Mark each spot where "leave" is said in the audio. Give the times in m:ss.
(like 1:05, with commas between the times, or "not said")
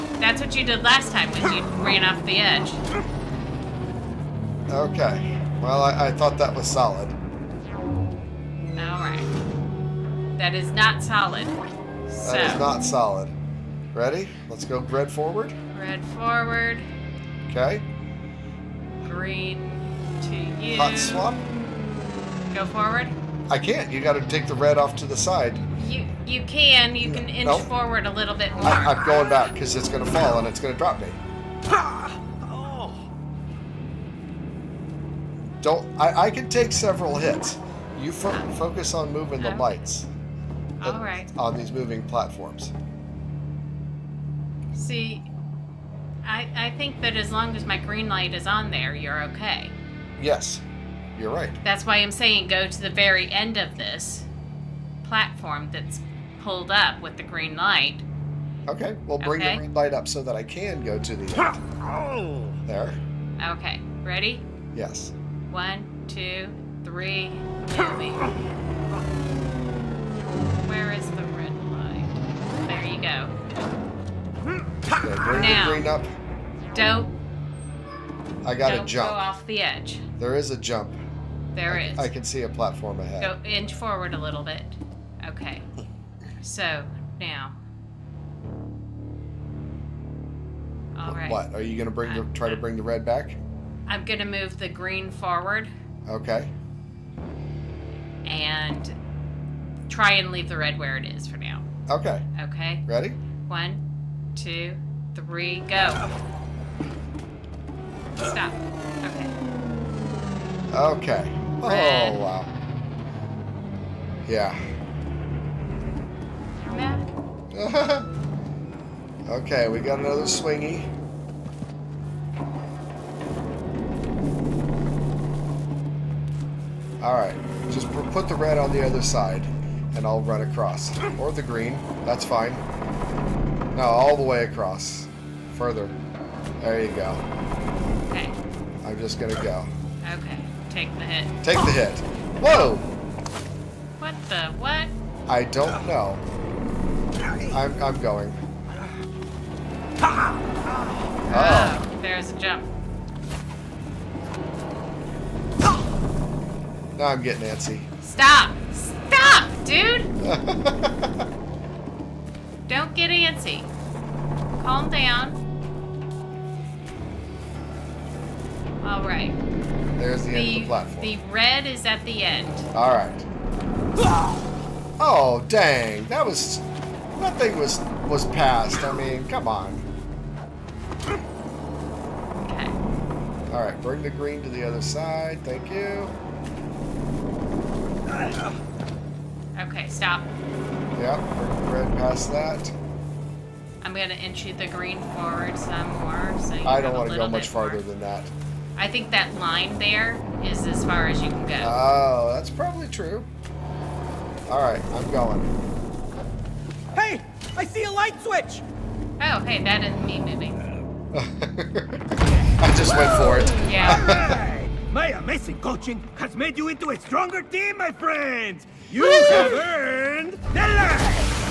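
1:40.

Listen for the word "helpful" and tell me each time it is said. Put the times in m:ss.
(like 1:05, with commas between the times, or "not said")
not said.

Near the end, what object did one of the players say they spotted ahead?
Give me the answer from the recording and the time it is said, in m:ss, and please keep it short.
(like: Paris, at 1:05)
light switch, at 3:27.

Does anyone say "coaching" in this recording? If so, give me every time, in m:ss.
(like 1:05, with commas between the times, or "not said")
3:35.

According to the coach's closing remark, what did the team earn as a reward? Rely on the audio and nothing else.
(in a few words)
the life.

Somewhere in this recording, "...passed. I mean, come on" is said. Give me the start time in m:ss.
2:58.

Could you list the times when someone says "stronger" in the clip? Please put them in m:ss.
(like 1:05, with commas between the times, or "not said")
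3:36.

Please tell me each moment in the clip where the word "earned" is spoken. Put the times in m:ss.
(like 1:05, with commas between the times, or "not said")
3:39.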